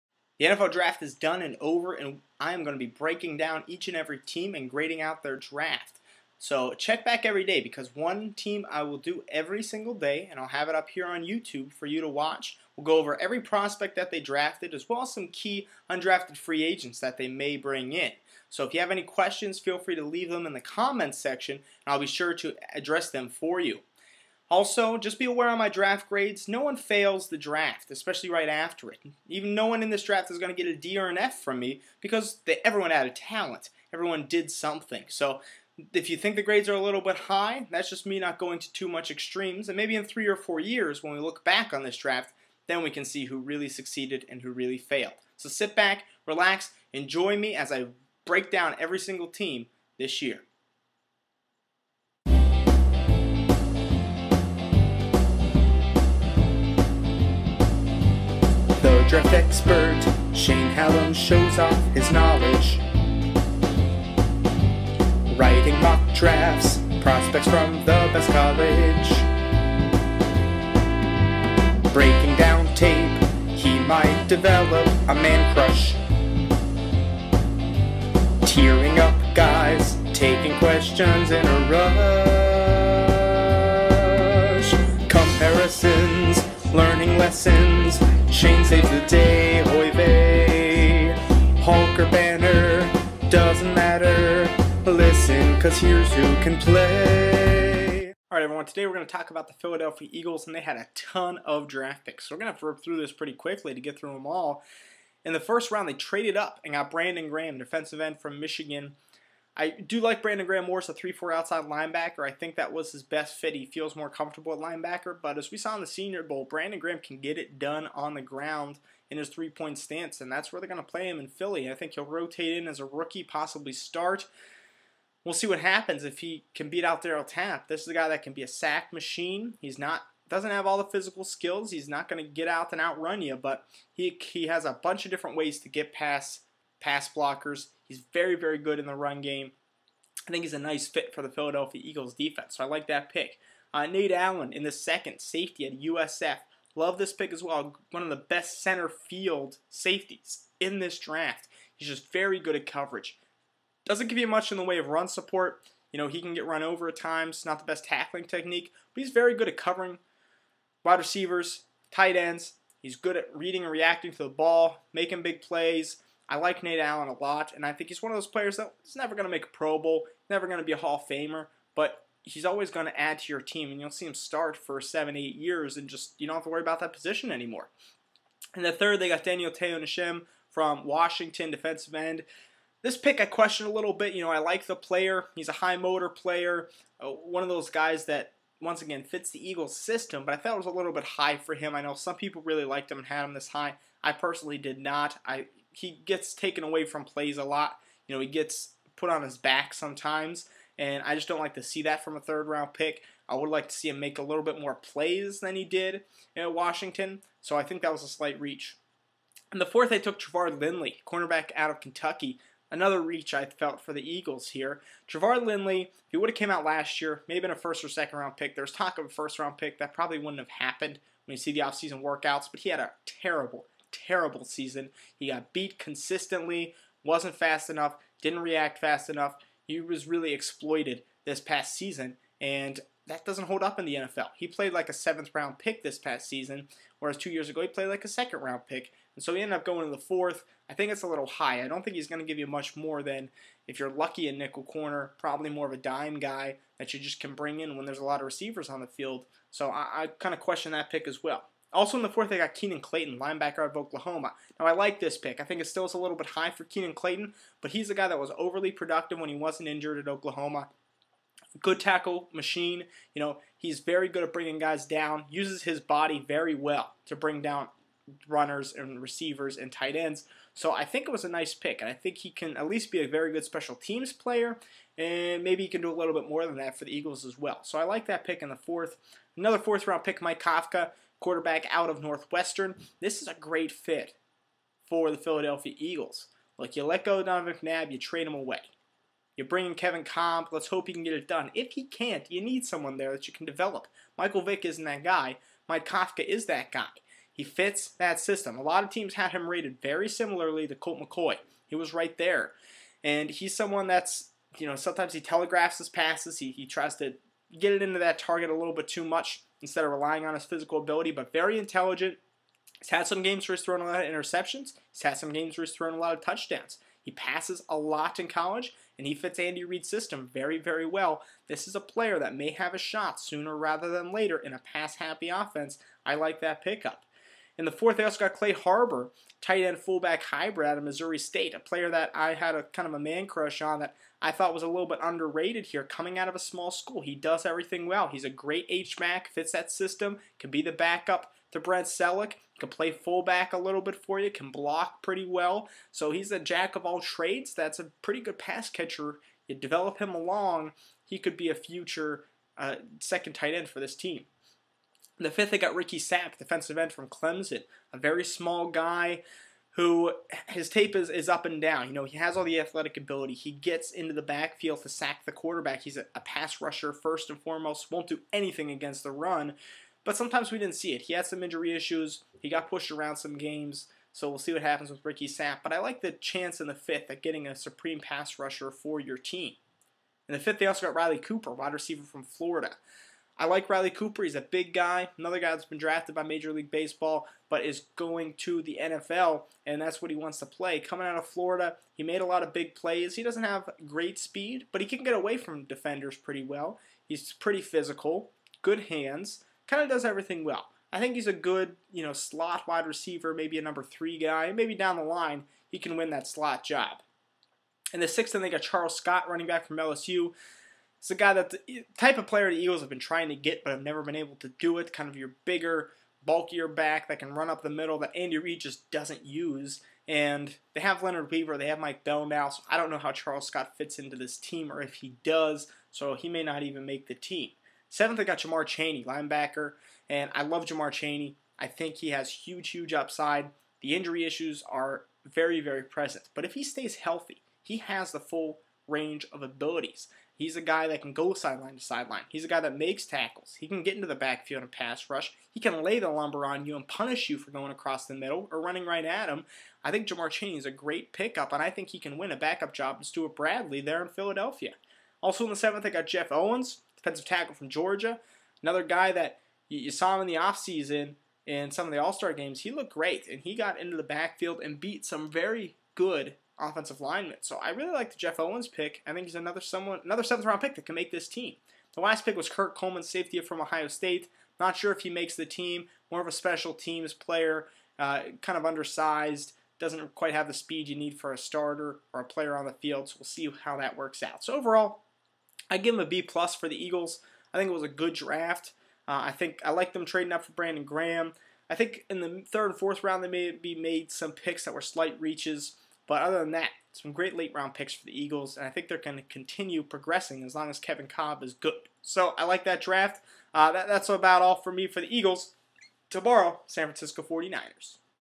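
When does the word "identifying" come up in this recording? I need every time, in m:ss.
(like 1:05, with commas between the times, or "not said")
not said.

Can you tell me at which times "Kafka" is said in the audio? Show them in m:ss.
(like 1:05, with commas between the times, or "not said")
4:40, 4:55.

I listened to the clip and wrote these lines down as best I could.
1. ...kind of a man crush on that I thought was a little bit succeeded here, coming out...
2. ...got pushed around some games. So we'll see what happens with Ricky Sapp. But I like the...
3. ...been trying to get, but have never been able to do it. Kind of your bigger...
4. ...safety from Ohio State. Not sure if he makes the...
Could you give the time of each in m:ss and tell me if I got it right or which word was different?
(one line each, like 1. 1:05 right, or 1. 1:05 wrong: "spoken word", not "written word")
1. 5:32 wrong: "underrated", not "succeeded"
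2. 6:12 right
3. 6:52 right
4. 7:53 right.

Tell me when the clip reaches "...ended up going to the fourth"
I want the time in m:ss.
3:59.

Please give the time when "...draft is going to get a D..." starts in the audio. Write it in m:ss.
0:30.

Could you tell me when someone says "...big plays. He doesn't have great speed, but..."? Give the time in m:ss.
6:32.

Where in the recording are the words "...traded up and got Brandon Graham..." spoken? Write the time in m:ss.
1:45.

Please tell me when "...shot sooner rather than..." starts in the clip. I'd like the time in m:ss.
5:22.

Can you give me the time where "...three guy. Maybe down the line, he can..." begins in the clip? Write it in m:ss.
6:43.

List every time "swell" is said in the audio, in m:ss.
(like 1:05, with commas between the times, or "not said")
not said.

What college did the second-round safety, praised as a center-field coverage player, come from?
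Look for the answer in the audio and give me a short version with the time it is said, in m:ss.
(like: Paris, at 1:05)
USF, at 2:25.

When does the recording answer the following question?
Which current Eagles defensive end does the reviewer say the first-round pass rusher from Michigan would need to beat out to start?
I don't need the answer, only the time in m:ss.
2:07.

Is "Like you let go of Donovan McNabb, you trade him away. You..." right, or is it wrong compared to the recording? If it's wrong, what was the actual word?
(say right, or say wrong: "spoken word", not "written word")
right.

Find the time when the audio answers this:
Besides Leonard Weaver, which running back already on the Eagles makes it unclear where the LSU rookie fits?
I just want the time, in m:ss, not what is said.
7:01.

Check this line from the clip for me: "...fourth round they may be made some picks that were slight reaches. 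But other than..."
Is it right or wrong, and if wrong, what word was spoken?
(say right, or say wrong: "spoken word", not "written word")
right.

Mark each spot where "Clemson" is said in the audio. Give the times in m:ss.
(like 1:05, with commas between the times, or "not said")
5:57.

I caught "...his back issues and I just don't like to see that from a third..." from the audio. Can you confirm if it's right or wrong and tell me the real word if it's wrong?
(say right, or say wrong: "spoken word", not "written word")
wrong: "sometimes", not "issues".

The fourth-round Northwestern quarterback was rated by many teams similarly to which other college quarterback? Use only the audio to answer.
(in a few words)
Colt McCoy.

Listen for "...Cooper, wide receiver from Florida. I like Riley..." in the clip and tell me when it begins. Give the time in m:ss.
6:21.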